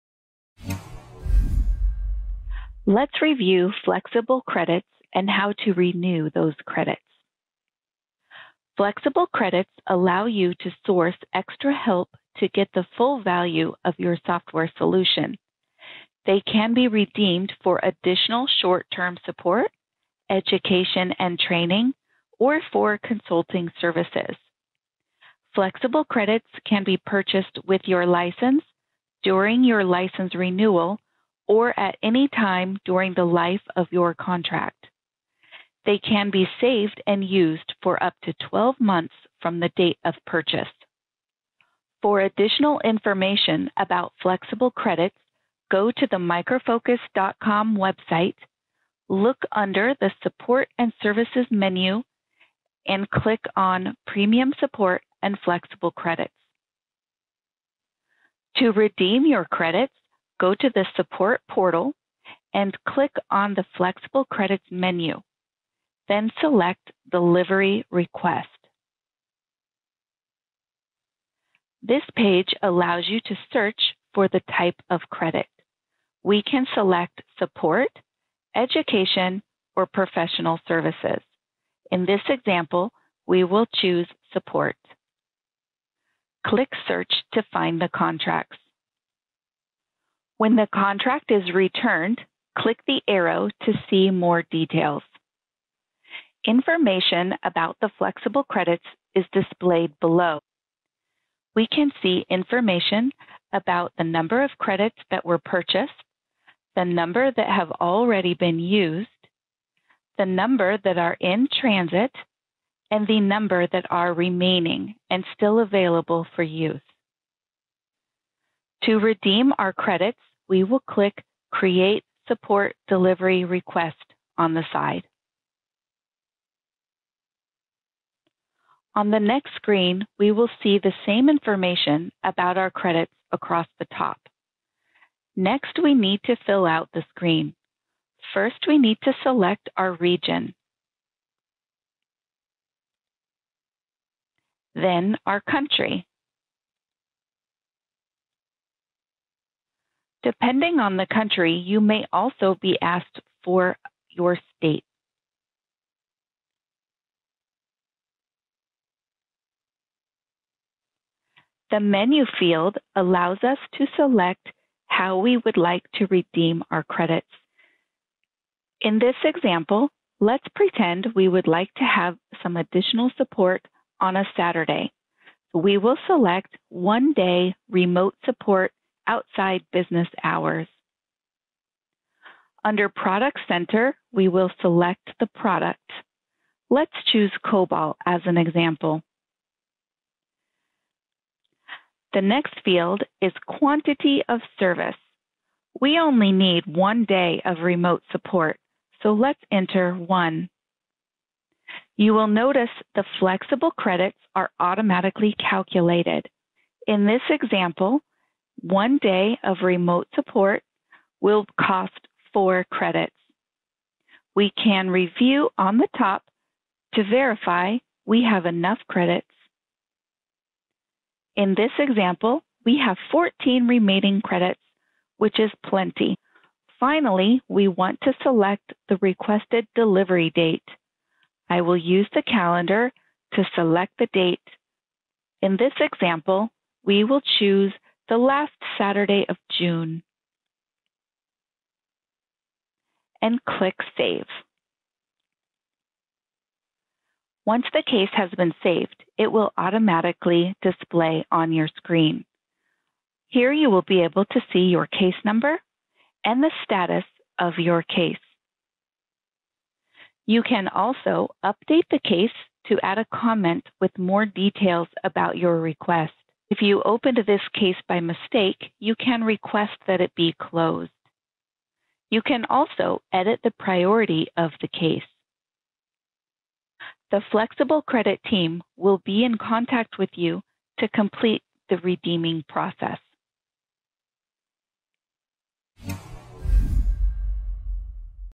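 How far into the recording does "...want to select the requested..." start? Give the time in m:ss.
3:47.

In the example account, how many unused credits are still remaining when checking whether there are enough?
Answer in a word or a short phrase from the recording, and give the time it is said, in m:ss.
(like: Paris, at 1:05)
14, at 3:43.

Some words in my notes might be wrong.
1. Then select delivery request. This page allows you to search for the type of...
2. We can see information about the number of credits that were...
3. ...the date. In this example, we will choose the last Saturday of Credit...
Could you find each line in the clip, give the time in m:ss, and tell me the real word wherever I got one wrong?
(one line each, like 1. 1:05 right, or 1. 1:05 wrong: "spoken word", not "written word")
1. 1:06 right
2. 1:41 right
3. 3:53 wrong: "June", not "Credit".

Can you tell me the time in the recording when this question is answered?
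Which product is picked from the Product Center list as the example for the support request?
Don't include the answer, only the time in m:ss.
3:07.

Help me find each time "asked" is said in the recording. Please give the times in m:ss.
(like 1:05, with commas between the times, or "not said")
2:32.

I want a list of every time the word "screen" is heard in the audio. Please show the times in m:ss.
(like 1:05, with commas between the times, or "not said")
2:09, 2:17, 4:11.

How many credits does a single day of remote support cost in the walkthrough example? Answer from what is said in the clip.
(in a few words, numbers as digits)
4.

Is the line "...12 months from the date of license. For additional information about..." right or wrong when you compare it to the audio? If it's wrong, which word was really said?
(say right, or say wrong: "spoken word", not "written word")
wrong: "purchase", not "license".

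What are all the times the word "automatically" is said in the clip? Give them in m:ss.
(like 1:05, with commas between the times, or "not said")
3:24, 4:09.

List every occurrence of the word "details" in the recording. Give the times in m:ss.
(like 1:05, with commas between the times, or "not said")
1:34, 4:24.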